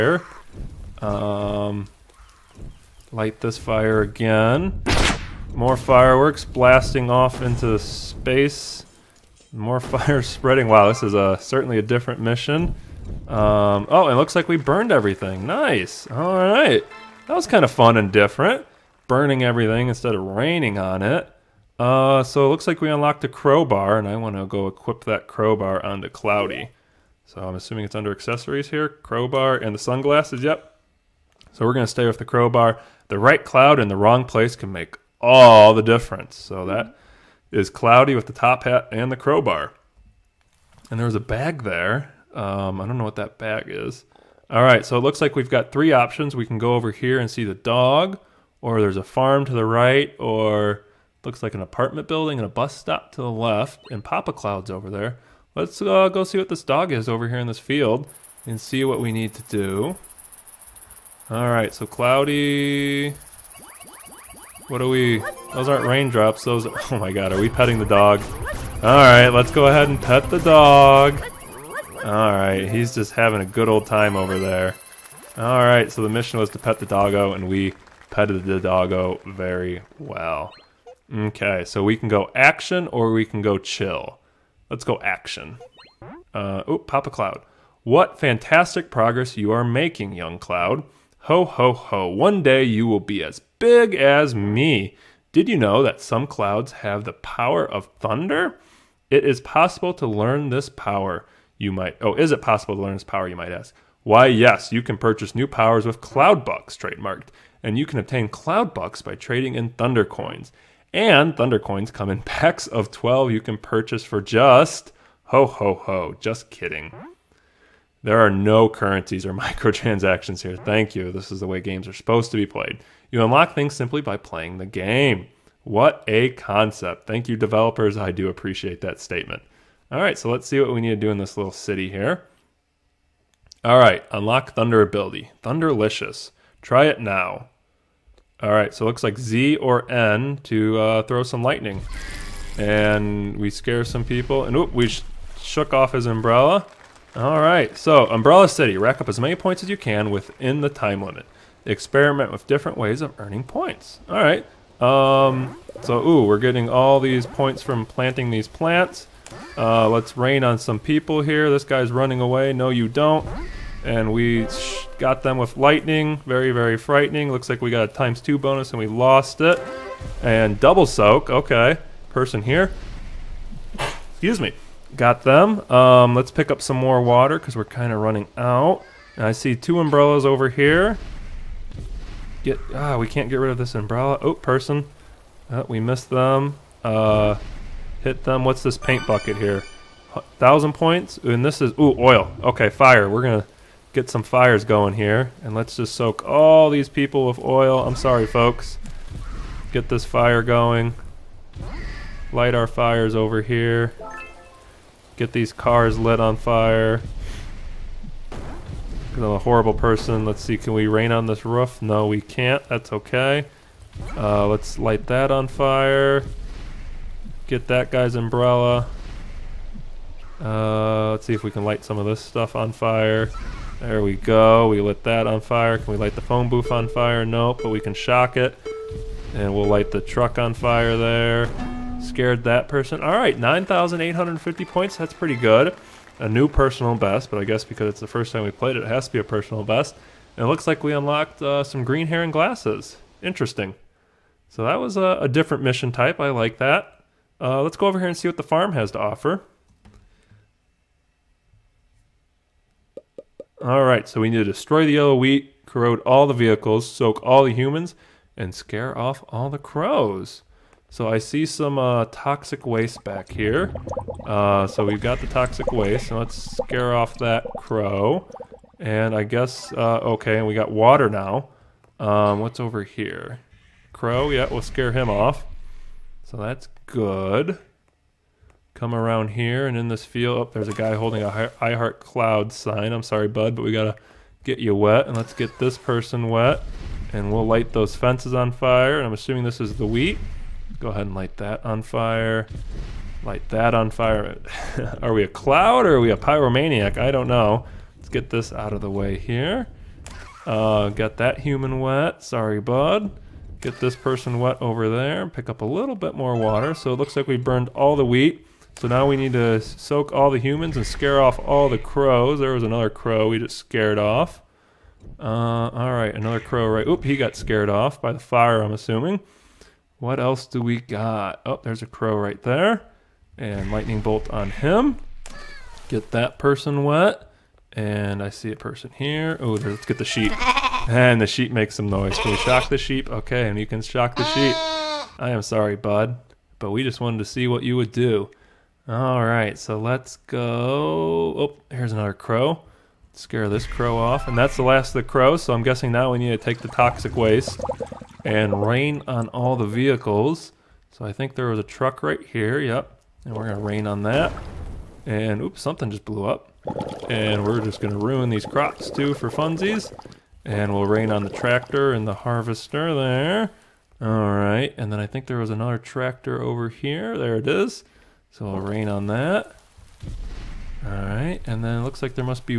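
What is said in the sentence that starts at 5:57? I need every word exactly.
And we're just gonna ruin these crops too for funsies.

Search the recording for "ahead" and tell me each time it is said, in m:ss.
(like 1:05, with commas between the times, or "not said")
1:09, 4:50.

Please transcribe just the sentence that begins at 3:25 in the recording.
Get these cars lit on fire.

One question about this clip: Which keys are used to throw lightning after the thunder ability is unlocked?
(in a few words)
Z or N.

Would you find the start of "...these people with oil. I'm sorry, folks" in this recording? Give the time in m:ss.
3:16.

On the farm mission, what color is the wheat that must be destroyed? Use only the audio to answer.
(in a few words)
Yellow.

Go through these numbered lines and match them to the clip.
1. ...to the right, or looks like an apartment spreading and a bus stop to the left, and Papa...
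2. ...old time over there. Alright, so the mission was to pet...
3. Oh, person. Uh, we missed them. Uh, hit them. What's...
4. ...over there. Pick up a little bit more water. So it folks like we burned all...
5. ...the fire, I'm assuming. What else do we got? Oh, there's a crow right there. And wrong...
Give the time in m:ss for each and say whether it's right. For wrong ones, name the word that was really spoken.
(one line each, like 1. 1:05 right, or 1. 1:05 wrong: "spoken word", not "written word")
1. 0:49 wrong: "building", not "spreading"
2. 1:13 right
3. 3:04 right
4. 5:04 wrong: "looks", not "folks"
5. 5:18 wrong: "lightning", not "wrong".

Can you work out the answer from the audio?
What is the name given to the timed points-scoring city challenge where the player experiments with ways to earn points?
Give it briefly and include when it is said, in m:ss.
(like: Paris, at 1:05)
Umbrella City, at 2:28.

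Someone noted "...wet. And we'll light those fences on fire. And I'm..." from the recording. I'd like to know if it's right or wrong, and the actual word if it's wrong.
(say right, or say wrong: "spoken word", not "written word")
right.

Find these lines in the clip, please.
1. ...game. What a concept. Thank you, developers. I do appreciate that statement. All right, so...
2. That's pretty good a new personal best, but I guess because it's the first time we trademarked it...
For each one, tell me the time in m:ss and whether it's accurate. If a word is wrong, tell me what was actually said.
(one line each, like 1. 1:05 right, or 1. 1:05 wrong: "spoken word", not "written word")
1. 2:04 right
2. 3:54 wrong: "played", not "trademarked".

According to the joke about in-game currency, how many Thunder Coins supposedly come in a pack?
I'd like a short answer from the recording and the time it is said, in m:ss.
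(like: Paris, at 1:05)
12, at 1:52.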